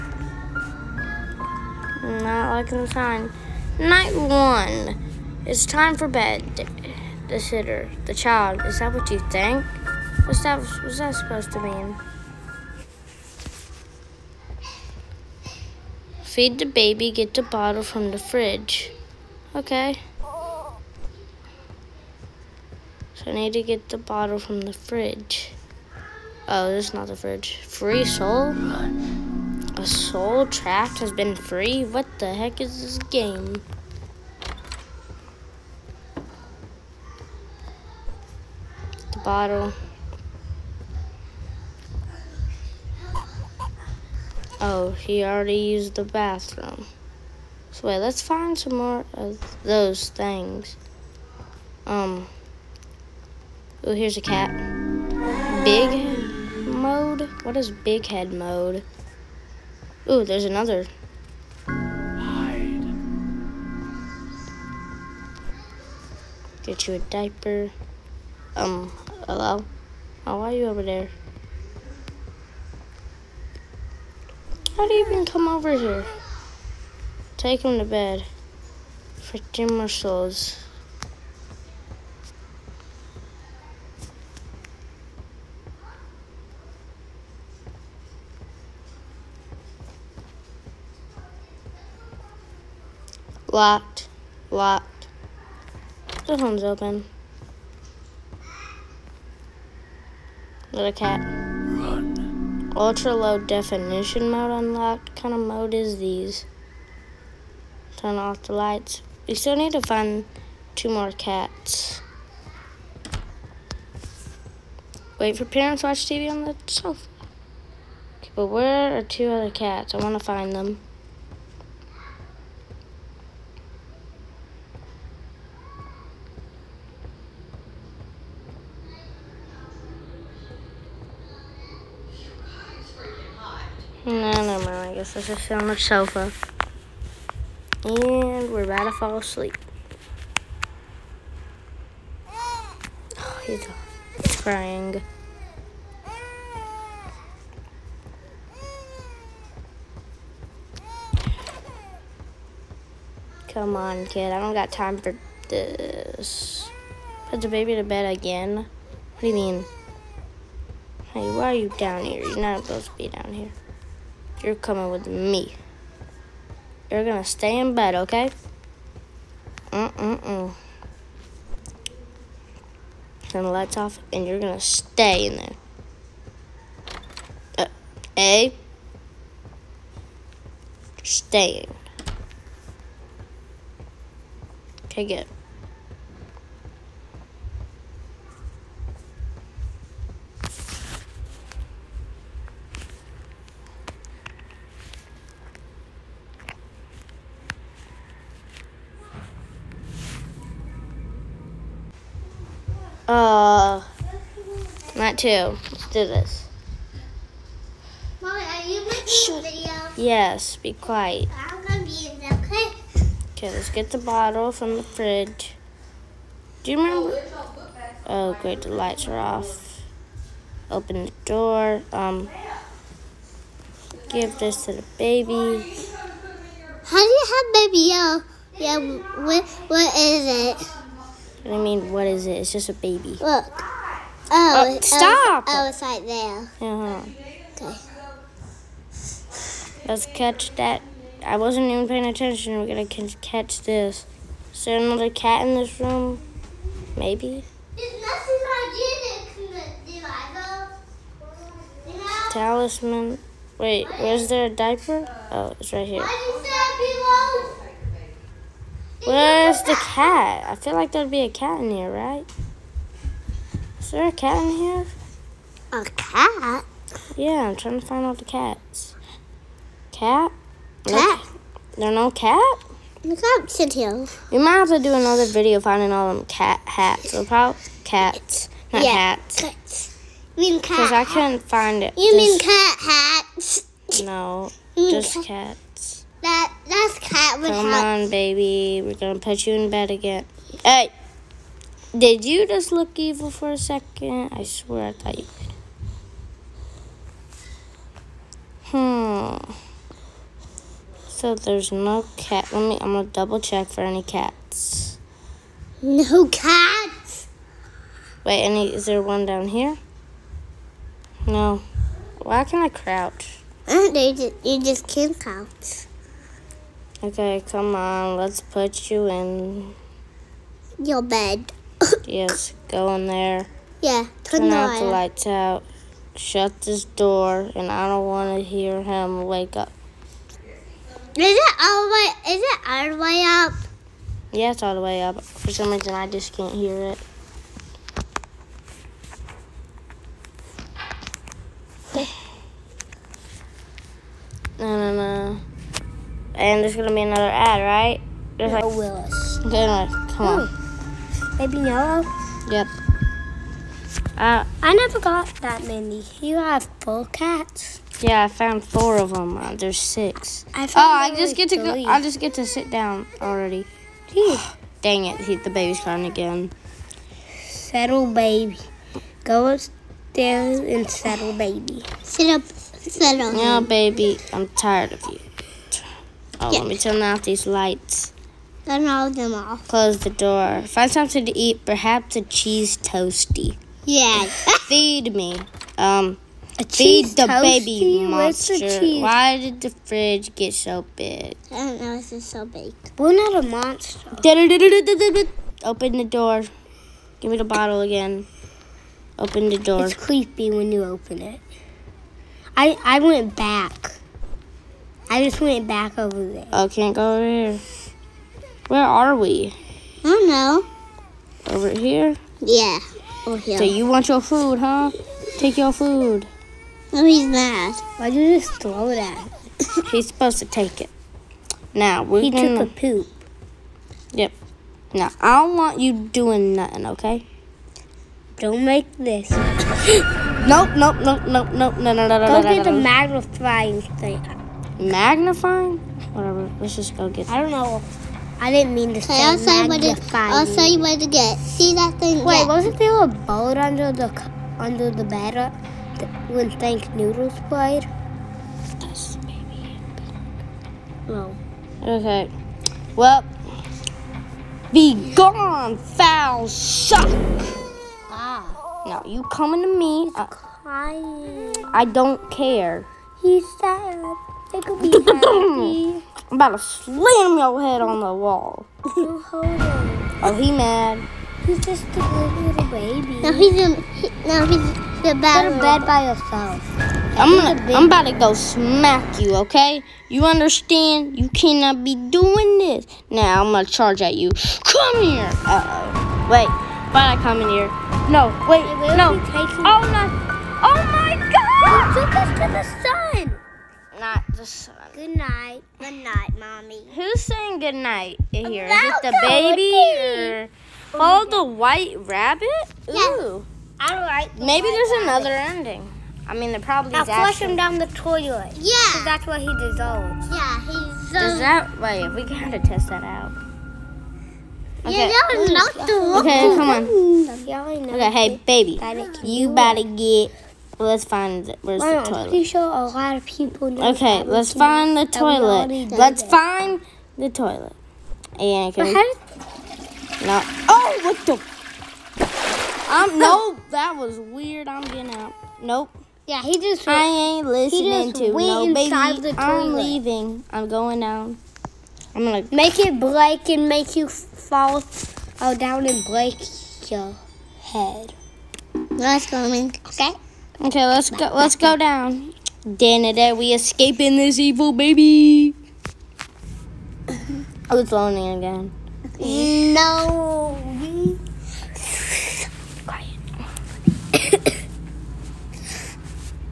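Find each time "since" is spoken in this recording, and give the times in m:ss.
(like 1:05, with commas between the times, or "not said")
not said.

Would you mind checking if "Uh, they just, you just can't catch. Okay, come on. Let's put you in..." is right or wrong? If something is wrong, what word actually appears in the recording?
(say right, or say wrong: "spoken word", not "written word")
wrong: "crouch", not "catch".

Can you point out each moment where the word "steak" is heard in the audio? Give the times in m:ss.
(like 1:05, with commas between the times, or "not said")
not said.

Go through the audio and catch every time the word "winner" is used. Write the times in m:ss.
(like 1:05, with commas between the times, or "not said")
not said.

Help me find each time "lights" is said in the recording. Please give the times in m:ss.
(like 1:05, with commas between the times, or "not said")
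1:48, 2:53, 3:38, 5:24, 6:17.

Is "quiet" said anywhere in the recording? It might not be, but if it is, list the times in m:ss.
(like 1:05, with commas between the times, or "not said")
3:30, 9:22.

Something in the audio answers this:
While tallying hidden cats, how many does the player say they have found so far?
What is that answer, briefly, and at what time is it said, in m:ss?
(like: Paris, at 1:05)
4, at 5:58.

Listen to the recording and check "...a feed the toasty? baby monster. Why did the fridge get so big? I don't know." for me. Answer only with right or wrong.
right.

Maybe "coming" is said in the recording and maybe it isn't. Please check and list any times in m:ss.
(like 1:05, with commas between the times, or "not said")
2:44, 7:39, 9:09.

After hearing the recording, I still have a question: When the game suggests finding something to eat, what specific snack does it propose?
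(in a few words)
cheese toasty.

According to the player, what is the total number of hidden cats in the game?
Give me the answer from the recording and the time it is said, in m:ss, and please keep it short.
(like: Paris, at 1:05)
6, at 5:59.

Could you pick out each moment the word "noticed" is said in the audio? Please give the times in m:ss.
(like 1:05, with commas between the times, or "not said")
not said.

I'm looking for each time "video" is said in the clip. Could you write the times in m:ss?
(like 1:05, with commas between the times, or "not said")
3:29, 4:35.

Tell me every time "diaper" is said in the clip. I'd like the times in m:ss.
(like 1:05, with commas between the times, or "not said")
1:06, 4:14.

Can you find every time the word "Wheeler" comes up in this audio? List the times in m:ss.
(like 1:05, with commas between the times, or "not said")
not said.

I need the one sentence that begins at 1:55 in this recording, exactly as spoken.
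Wait for parents watch TV on the sofa.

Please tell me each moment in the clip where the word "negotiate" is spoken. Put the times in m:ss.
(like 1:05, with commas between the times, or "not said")
not said.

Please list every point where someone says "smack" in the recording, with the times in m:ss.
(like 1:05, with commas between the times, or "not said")
7:58.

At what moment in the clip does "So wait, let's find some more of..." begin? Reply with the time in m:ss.
0:47.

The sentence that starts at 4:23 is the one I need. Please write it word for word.
Is there a cat in here?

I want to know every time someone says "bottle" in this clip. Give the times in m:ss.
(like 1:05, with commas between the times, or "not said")
0:17, 0:23, 0:39, 3:33, 6:37.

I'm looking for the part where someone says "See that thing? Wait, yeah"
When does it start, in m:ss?
7:21.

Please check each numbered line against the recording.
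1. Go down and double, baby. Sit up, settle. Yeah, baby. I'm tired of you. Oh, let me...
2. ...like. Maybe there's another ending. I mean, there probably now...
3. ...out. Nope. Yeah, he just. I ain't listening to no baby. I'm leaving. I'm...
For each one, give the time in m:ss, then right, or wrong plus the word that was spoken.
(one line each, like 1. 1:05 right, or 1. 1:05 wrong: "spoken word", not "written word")
1. 6:09 wrong: "settle", not "double"
2. 8:24 right
3. 8:55 right.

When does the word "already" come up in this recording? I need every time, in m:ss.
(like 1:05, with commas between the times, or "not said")
0:45, 6:03.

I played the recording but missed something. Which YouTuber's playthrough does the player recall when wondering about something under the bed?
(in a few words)
Thank Noodles.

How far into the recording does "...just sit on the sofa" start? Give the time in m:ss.
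2:15.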